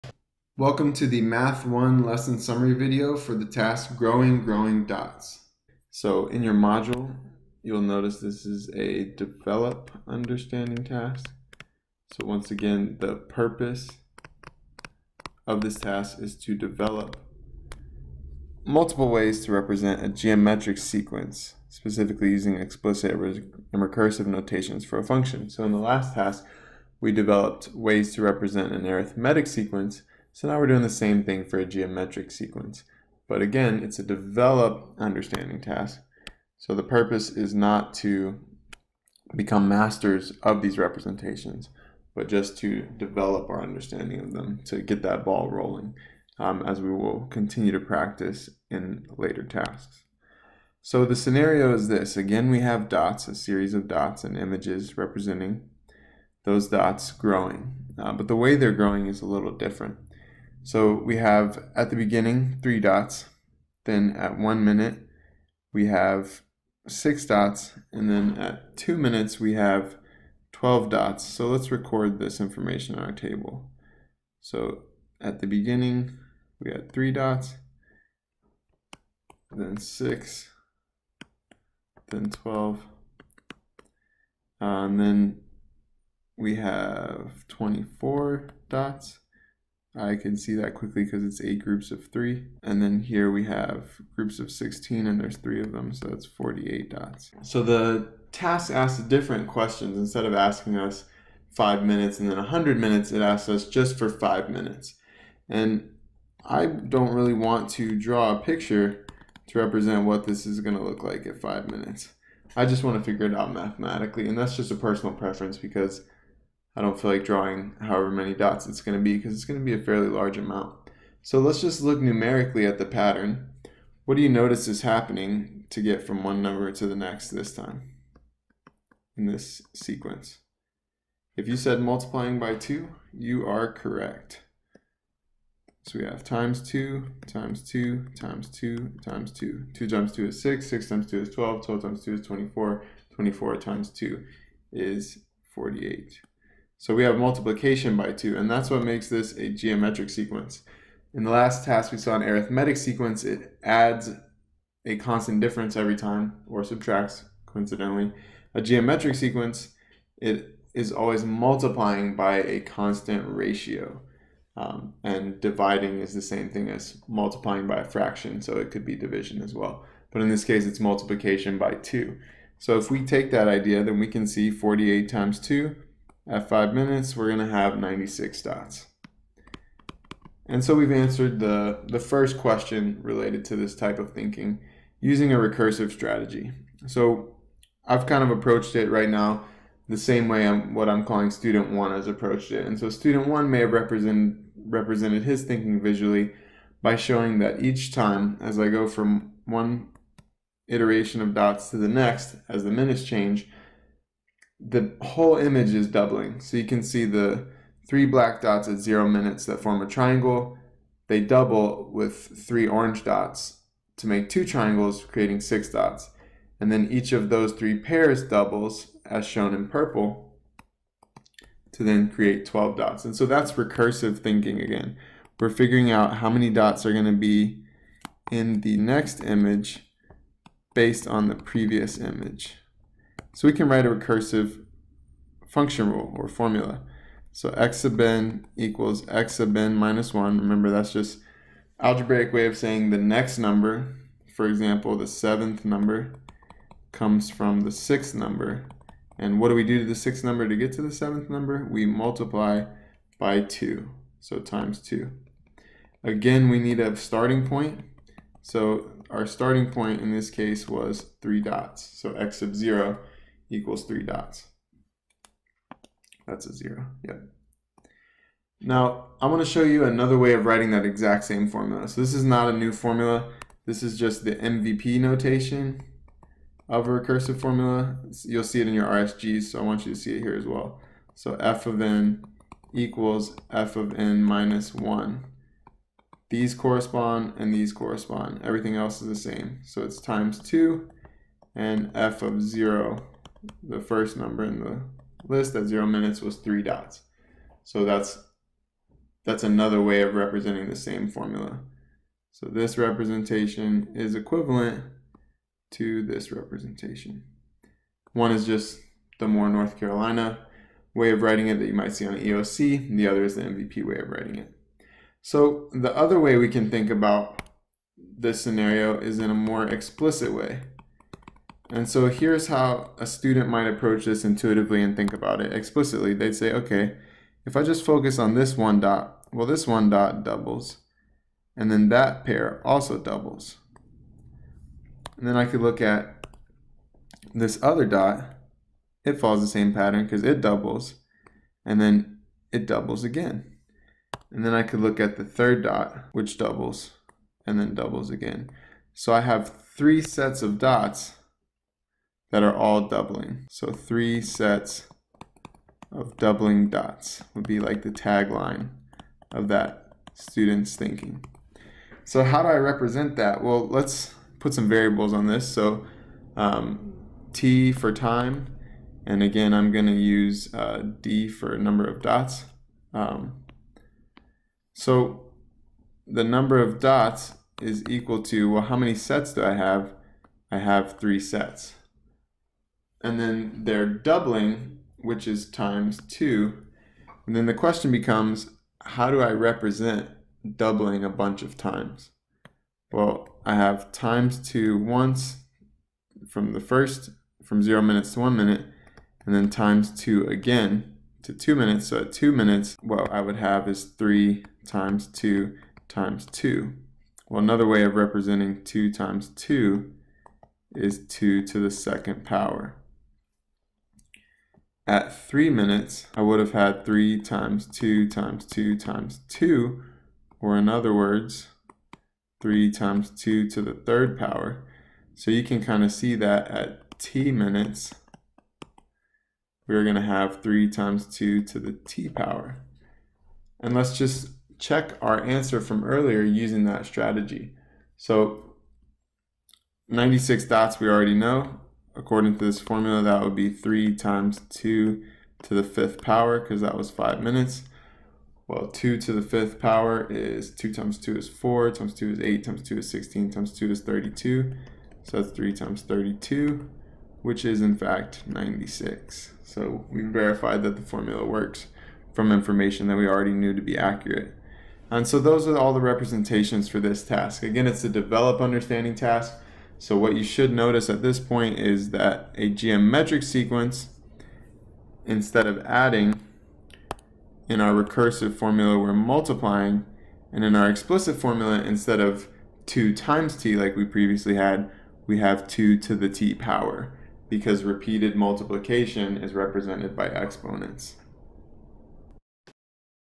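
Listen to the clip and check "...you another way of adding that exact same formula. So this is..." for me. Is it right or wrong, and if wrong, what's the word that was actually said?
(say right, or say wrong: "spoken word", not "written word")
wrong: "writing", not "adding".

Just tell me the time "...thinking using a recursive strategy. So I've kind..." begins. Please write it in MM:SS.
03:04.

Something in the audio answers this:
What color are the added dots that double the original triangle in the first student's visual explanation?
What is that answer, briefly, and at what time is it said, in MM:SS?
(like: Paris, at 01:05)
Orange, at 03:32.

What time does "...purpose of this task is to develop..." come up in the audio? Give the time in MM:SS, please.
00:13.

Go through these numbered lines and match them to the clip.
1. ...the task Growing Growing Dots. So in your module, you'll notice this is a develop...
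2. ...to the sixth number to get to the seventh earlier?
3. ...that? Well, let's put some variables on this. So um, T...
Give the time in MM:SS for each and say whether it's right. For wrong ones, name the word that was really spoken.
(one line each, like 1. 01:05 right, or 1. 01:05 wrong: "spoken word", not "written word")
1. 00:03 right
2. 04:09 wrong: "number", not "earlier"
3. 06:03 right.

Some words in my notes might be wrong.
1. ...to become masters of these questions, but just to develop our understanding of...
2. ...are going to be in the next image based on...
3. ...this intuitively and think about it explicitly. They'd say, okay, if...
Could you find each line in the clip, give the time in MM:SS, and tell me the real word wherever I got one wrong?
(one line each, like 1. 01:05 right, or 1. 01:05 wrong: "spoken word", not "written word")
1. 00:37 wrong: "representations", not "questions"
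2. 03:46 right
3. 05:24 right.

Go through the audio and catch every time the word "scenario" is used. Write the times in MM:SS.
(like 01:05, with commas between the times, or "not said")
00:51, 05:18.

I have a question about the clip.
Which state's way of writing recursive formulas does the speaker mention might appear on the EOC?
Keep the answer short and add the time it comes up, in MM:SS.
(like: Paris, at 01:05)
North Carolina, at 05:09.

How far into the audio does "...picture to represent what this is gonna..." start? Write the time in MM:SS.
01:48.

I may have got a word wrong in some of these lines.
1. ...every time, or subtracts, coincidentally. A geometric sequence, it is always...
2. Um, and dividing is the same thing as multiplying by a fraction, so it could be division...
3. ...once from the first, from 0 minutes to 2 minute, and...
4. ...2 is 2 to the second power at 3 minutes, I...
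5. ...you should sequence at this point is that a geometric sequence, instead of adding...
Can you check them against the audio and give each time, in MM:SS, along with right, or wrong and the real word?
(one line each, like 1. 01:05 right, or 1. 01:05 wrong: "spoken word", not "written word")
1. 02:35 right
2. 02:44 right
3. 06:34 wrong: "1", not "2"
4. 06:49 right
5. 07:50 wrong: "notice", not "sequence".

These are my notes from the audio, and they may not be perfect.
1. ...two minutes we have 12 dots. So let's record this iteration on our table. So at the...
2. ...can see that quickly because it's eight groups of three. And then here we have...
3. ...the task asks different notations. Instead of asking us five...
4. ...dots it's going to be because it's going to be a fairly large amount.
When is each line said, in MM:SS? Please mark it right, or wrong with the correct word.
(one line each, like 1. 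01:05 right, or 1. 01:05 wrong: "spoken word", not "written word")
1. 01:08 wrong: "information", not "iteration"
2. 01:30 right
3. 01:37 wrong: "questions", not "notations"
4. 01:58 right.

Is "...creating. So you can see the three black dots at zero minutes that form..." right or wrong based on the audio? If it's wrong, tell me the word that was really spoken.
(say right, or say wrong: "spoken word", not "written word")
wrong: "doubling", not "creating".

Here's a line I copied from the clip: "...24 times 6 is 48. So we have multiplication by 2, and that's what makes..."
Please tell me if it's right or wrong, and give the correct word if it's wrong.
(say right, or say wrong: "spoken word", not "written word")
wrong: "2", not "6".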